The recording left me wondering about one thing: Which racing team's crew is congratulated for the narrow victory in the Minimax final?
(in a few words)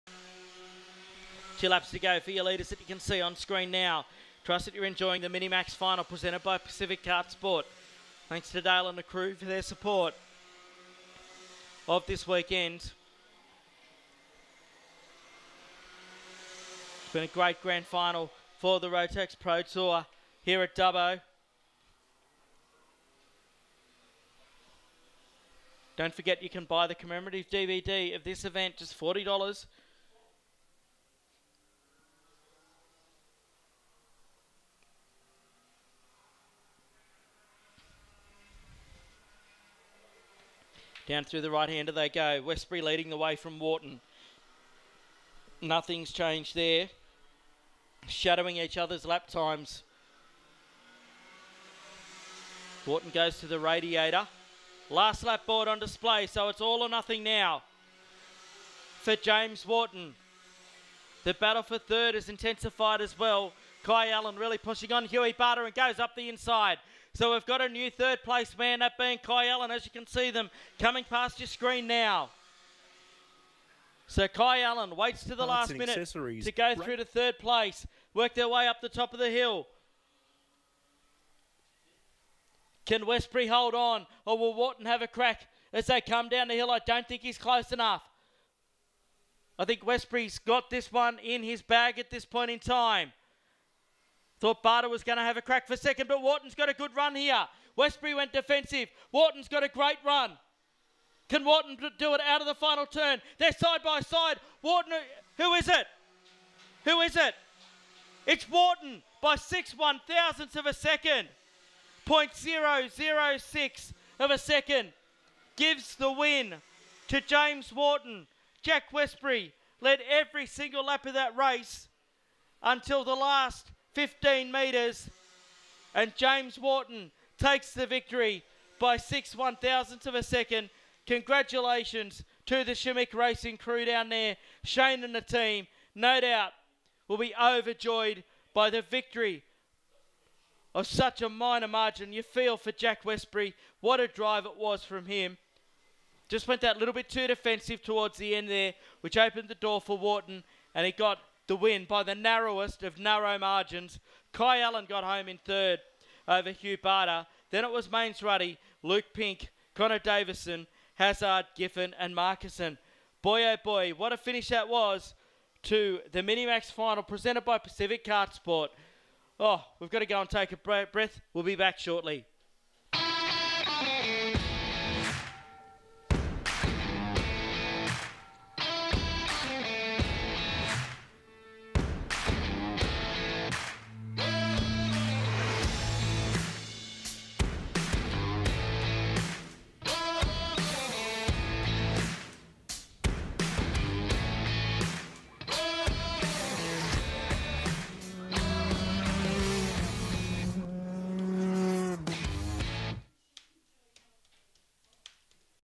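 Shimmick Racing.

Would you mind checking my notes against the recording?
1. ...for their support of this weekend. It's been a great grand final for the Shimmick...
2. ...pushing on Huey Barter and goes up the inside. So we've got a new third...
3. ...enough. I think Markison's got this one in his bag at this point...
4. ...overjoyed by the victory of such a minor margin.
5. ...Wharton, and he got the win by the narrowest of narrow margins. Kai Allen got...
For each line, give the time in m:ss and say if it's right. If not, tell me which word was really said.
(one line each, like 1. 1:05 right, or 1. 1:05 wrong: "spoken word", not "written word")
1. 0:09 wrong: "Rotax", not "Shimmick"
2. 1:04 right
3. 1:27 wrong: "Westbury", not "Markison"
4. 2:17 right
5. 2:29 right.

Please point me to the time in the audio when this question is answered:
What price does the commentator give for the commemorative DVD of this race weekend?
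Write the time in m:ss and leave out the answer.
0:28.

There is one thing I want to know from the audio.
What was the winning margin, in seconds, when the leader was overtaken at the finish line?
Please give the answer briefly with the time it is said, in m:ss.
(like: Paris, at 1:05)
0.006, at 1:52.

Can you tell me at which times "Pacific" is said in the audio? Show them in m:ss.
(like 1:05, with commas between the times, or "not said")
0:06, 2:47.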